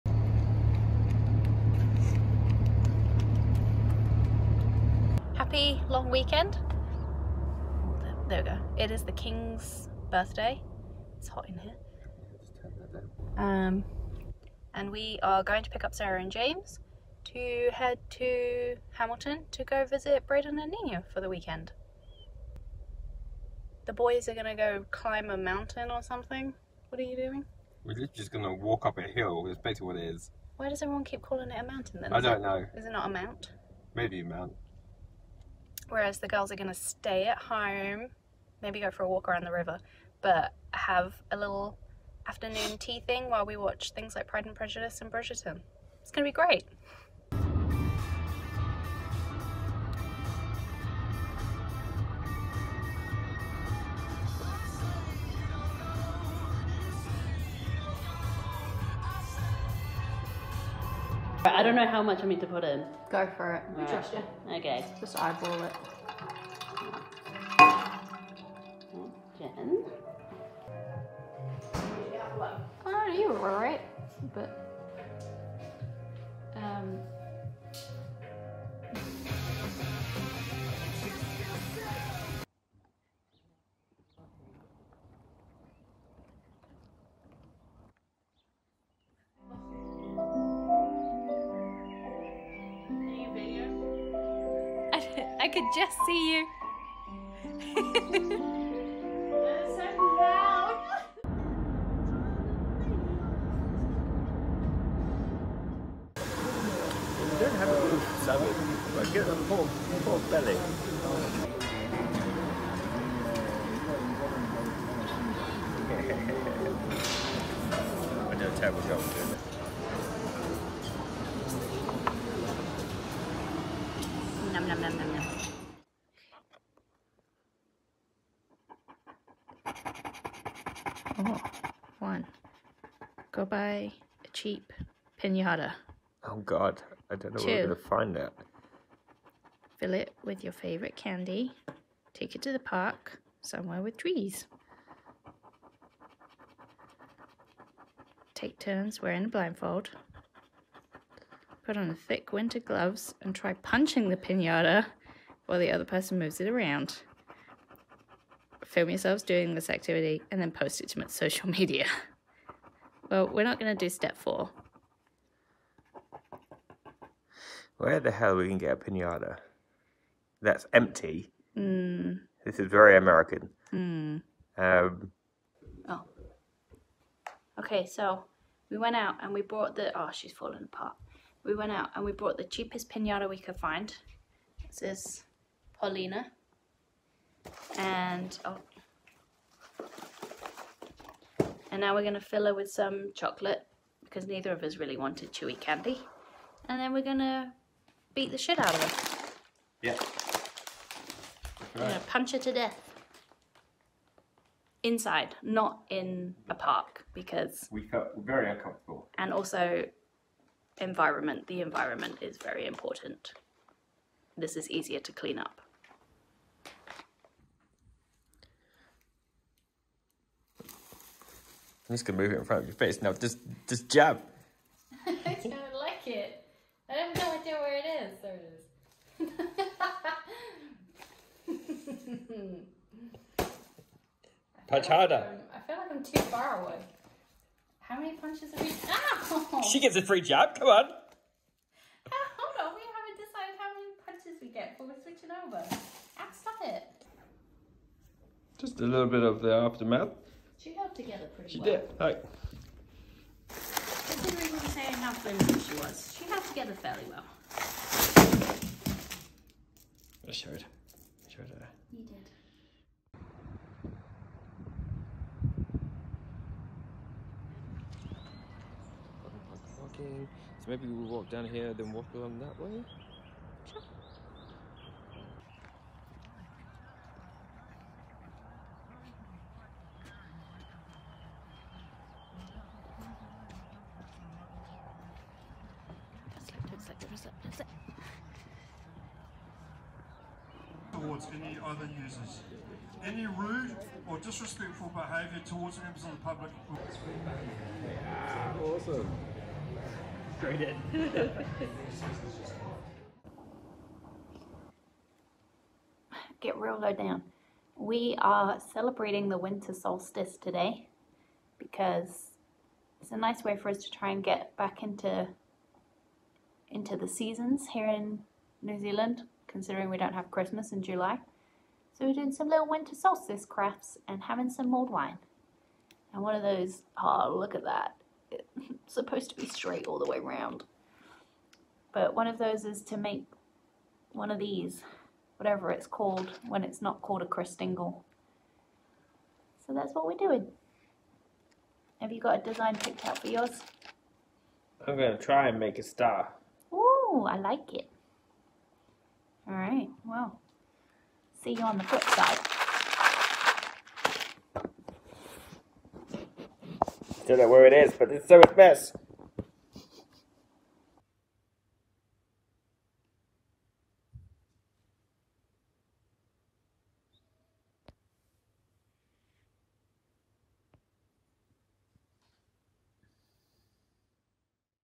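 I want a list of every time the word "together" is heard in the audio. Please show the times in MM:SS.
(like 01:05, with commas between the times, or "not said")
04:10, 04:16.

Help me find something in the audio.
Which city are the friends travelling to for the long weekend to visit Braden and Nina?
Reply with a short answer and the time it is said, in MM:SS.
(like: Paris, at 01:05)
Hamilton, at 00:18.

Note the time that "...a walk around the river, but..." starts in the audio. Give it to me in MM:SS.
00:39.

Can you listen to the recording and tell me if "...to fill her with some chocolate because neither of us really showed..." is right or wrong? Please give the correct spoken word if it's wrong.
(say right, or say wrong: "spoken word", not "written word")
wrong: "wanted", not "showed".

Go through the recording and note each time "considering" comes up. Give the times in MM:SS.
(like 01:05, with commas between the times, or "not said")
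04:13, 05:19.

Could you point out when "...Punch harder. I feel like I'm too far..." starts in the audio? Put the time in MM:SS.
03:54.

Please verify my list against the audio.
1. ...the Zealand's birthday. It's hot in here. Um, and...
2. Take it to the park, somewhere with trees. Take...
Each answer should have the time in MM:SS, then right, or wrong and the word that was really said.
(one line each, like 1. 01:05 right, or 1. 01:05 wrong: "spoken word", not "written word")
1. 00:09 wrong: "King", not "Zealand"
2. 02:22 right.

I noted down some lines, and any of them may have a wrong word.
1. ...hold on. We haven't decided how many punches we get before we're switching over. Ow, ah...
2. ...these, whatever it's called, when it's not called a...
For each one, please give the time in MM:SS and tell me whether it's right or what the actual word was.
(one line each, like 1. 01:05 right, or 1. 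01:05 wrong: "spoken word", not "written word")
1. 04:02 right
2. 05:34 right.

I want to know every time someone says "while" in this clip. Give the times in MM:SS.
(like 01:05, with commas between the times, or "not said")
00:43, 02:35.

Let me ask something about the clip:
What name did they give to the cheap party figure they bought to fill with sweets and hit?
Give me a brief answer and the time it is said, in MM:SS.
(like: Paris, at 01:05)
Paulina, at 03:05.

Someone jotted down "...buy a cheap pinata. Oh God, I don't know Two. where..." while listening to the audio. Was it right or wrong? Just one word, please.
right.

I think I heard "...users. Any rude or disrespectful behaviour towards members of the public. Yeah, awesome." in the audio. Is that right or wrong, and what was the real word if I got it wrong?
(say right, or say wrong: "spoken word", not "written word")
right.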